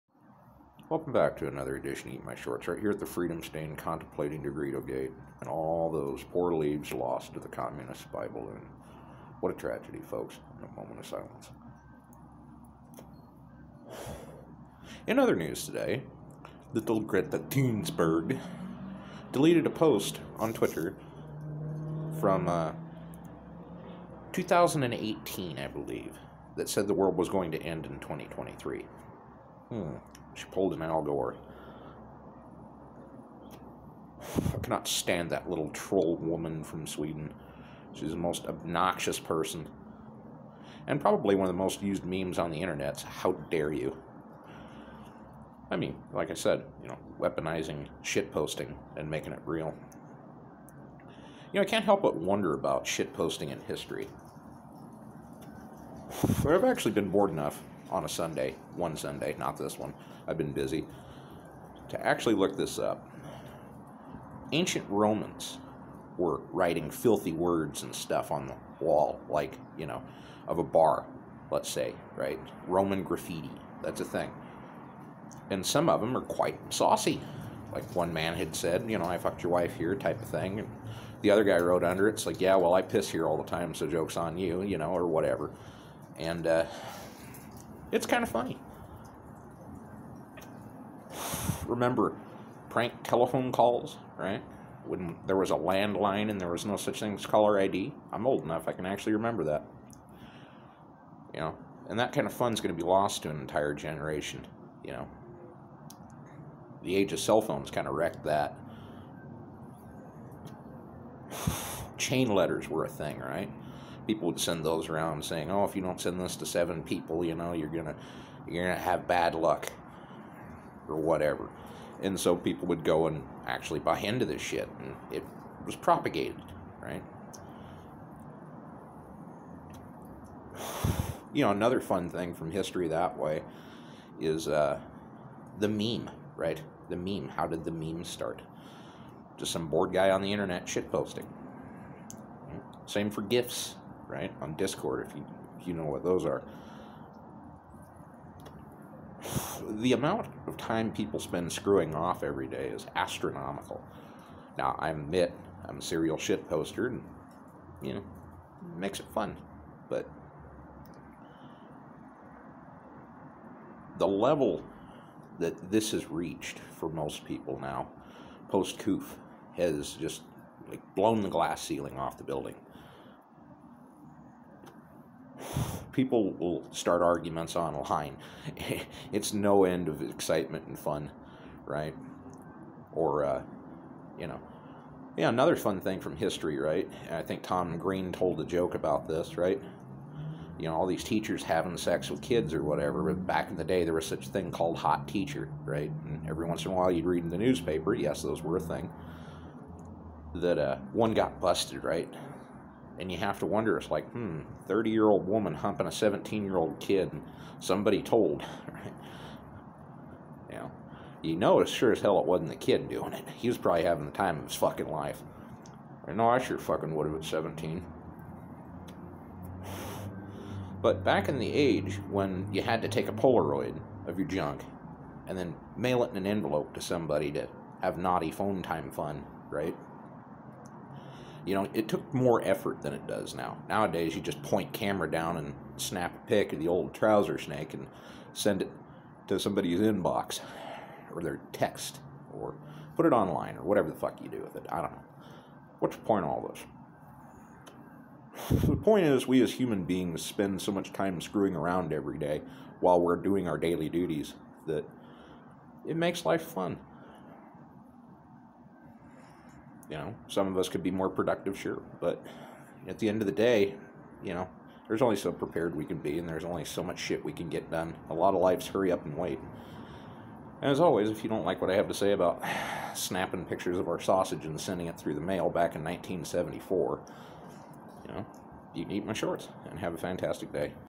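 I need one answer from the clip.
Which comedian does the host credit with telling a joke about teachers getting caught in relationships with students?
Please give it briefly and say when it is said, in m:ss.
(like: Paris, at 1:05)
Tom Green, at 3:07.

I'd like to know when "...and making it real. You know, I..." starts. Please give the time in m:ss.
0:48.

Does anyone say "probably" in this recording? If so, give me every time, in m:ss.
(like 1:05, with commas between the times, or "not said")
0:41, 3:33.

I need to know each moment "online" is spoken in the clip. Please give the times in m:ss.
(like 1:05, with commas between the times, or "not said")
2:57, 4:03.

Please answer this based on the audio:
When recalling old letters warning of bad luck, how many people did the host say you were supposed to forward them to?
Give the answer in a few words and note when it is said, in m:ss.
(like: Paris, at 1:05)
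7, at 1:56.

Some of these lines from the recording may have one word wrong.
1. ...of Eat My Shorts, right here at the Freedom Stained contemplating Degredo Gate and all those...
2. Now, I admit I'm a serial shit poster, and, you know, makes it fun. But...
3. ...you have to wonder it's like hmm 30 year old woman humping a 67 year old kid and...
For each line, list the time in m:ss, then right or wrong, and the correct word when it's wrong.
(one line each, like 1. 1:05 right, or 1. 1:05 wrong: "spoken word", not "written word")
1. 0:02 right
2. 2:34 right
3. 3:23 wrong: "17", not "67".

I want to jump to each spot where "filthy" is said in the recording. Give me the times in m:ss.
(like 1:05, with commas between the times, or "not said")
1:06.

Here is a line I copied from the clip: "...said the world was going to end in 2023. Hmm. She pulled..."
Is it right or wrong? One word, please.
right.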